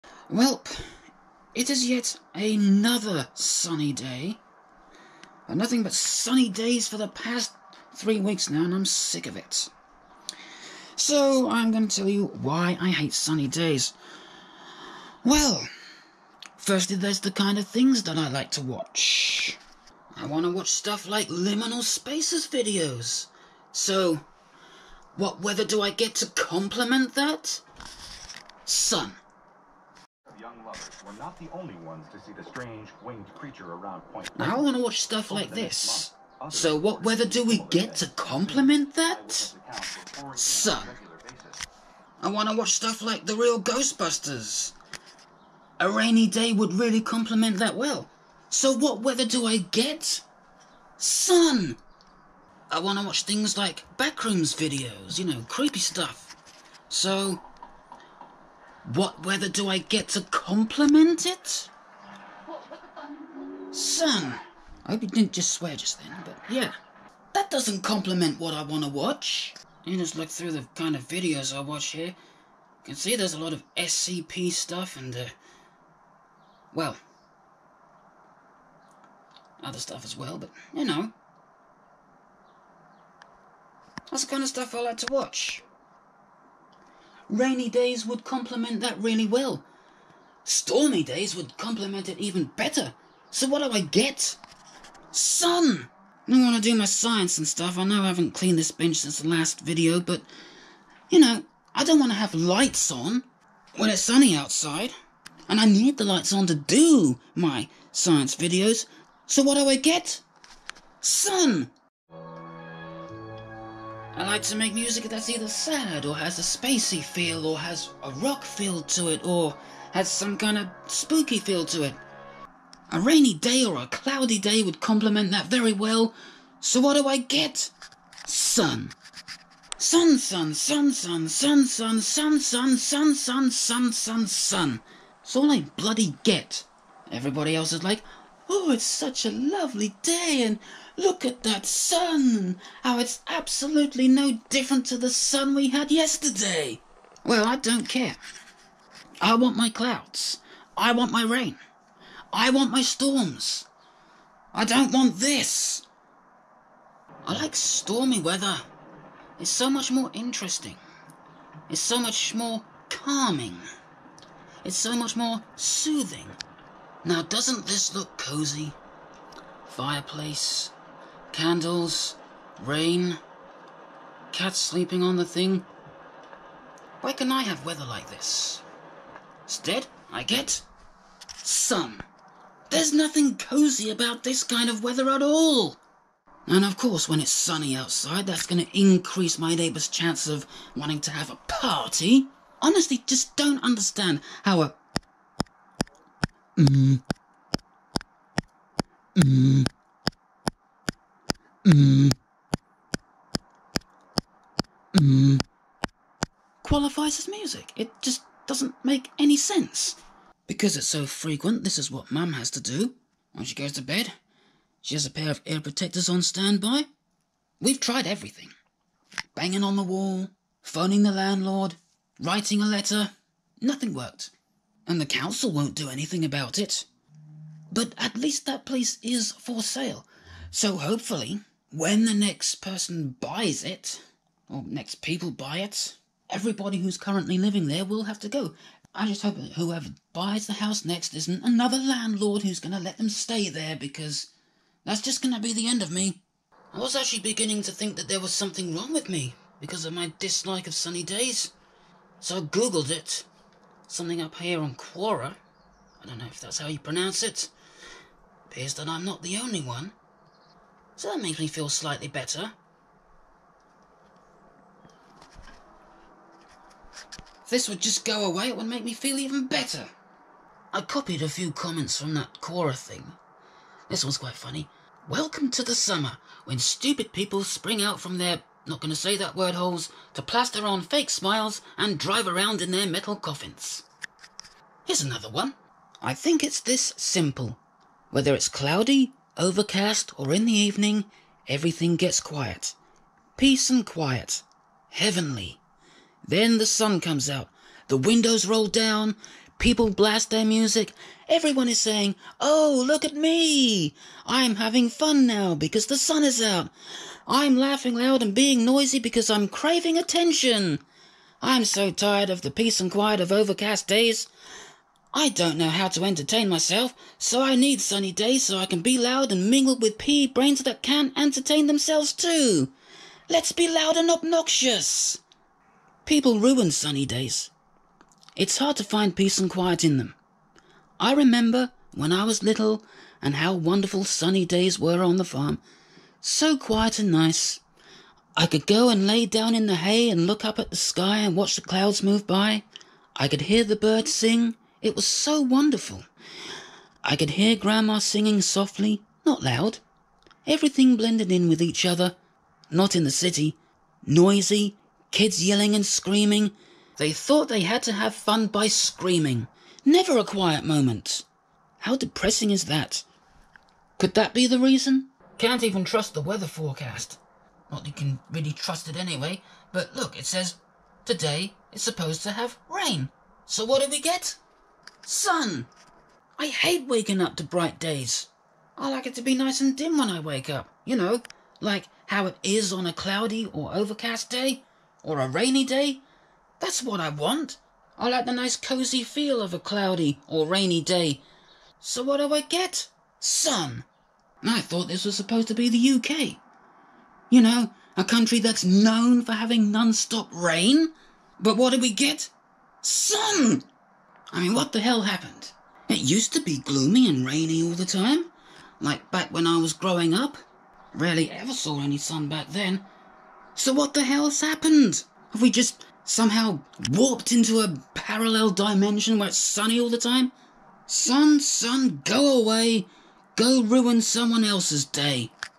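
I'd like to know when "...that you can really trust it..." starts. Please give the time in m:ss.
6:07.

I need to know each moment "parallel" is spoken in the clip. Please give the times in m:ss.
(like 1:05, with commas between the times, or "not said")
6:57.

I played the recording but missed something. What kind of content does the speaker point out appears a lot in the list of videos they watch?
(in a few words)
SCP.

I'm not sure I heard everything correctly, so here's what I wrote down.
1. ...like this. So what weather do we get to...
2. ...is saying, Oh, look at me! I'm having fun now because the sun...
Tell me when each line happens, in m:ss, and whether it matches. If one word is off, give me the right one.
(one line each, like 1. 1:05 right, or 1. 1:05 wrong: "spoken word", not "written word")
1. 0:35 right
2. 5:01 right.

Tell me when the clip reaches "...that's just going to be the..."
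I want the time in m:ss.
4:04.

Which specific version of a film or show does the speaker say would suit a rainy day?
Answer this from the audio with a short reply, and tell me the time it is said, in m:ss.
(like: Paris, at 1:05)
The real Ghostbusters, at 0:43.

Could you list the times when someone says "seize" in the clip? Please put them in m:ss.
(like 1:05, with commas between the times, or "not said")
not said.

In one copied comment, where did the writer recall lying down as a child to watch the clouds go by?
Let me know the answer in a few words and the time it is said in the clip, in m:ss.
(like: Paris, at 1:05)
In the hay, at 5:39.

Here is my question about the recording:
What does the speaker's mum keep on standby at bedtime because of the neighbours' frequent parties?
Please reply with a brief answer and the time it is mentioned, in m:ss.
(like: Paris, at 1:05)
Ear protectors, at 3:35.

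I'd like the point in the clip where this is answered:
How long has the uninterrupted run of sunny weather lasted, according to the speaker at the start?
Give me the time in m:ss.
0:07.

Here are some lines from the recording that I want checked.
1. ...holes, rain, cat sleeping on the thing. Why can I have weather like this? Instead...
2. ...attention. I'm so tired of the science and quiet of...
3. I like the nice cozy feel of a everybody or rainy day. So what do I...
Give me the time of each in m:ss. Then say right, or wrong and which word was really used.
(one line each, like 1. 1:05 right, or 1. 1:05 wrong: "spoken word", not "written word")
1. 2:51 wrong: "candles", not "holes"
2. 5:09 wrong: "peace", not "science"
3. 6:27 wrong: "cloudy", not "everybody".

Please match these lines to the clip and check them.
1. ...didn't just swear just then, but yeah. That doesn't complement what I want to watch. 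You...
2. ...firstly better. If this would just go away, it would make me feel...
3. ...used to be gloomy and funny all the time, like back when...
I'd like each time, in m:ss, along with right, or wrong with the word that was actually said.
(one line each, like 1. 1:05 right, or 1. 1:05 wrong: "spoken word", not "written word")
1. 1:05 right
2. 4:21 wrong: "slightly", not "firstly"
3. 6:45 wrong: "rainy", not "funny".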